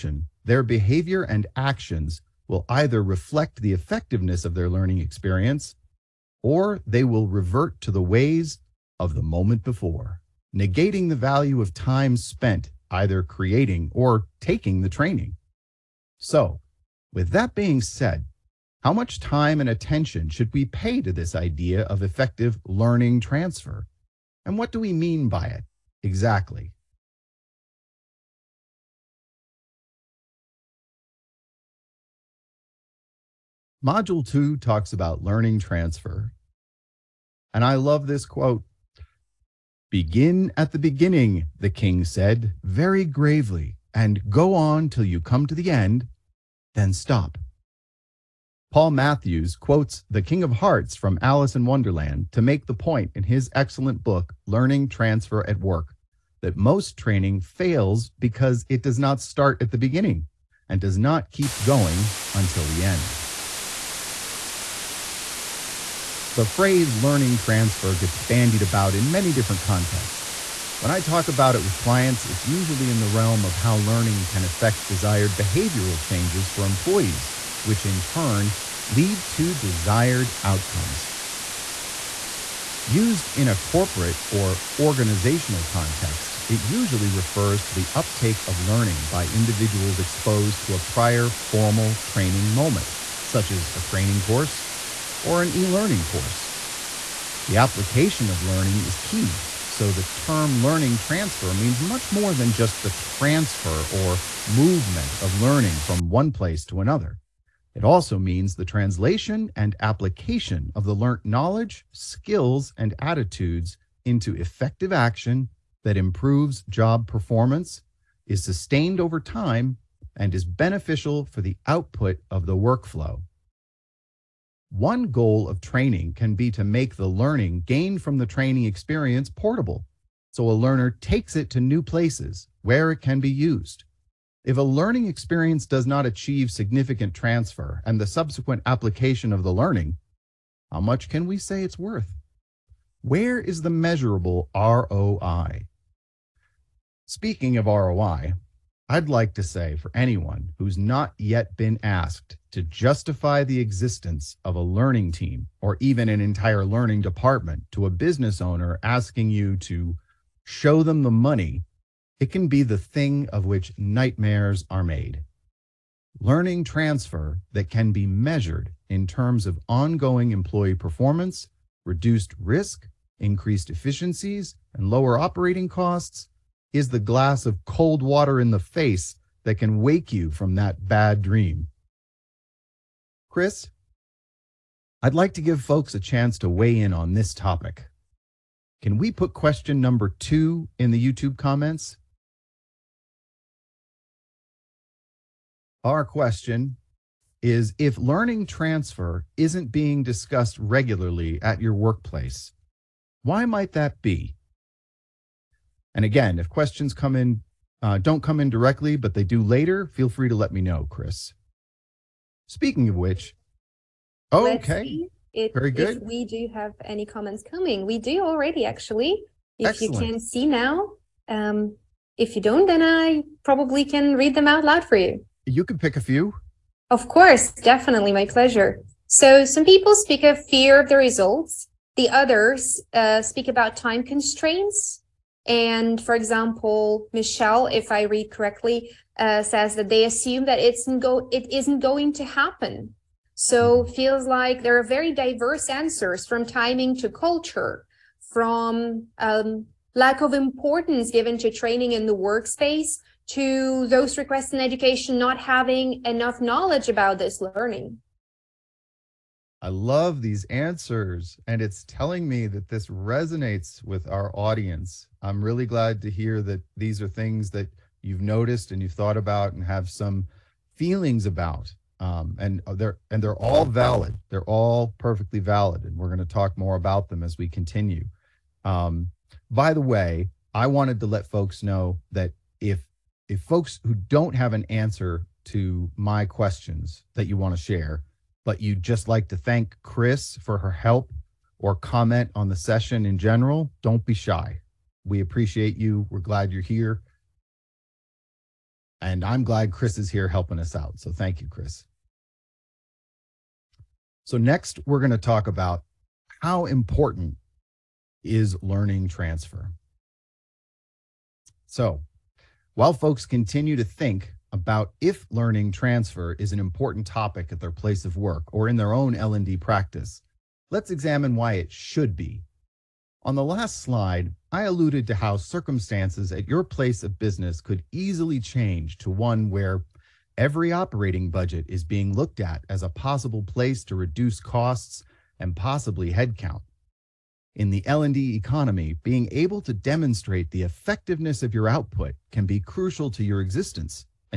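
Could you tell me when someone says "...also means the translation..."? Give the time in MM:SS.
01:47.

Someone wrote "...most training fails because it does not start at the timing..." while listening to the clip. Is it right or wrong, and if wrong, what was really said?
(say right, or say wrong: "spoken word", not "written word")
wrong: "beginning", not "timing".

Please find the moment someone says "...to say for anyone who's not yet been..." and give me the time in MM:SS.
02:29.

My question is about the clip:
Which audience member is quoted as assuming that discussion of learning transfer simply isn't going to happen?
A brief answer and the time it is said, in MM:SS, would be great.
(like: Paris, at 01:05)
Michelle, at 03:57.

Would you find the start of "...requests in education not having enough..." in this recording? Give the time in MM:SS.
04:14.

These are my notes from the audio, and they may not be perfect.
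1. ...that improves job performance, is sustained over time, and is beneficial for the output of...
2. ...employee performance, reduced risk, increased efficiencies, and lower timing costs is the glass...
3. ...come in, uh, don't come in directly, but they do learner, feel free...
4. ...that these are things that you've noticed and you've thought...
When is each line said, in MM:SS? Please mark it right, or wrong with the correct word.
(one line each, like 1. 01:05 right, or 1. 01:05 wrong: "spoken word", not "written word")
1. 01:55 right
2. 02:50 wrong: "operating", not "timing"
3. 03:26 wrong: "later", not "learner"
4. 04:26 right.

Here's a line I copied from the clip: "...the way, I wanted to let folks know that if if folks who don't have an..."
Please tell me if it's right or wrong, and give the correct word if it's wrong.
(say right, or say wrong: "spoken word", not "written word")
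right.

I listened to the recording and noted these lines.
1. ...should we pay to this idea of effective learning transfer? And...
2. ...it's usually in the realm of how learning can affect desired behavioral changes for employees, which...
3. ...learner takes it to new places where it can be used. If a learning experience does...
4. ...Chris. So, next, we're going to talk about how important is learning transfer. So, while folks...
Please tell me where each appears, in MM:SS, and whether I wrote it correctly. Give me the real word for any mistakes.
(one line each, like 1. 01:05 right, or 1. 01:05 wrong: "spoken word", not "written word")
1. 00:20 right
2. 01:12 right
3. 02:10 right
4. 05:01 right.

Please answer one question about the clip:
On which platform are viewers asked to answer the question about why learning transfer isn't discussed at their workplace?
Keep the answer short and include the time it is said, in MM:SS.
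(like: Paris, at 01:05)
YouTube, at 03:11.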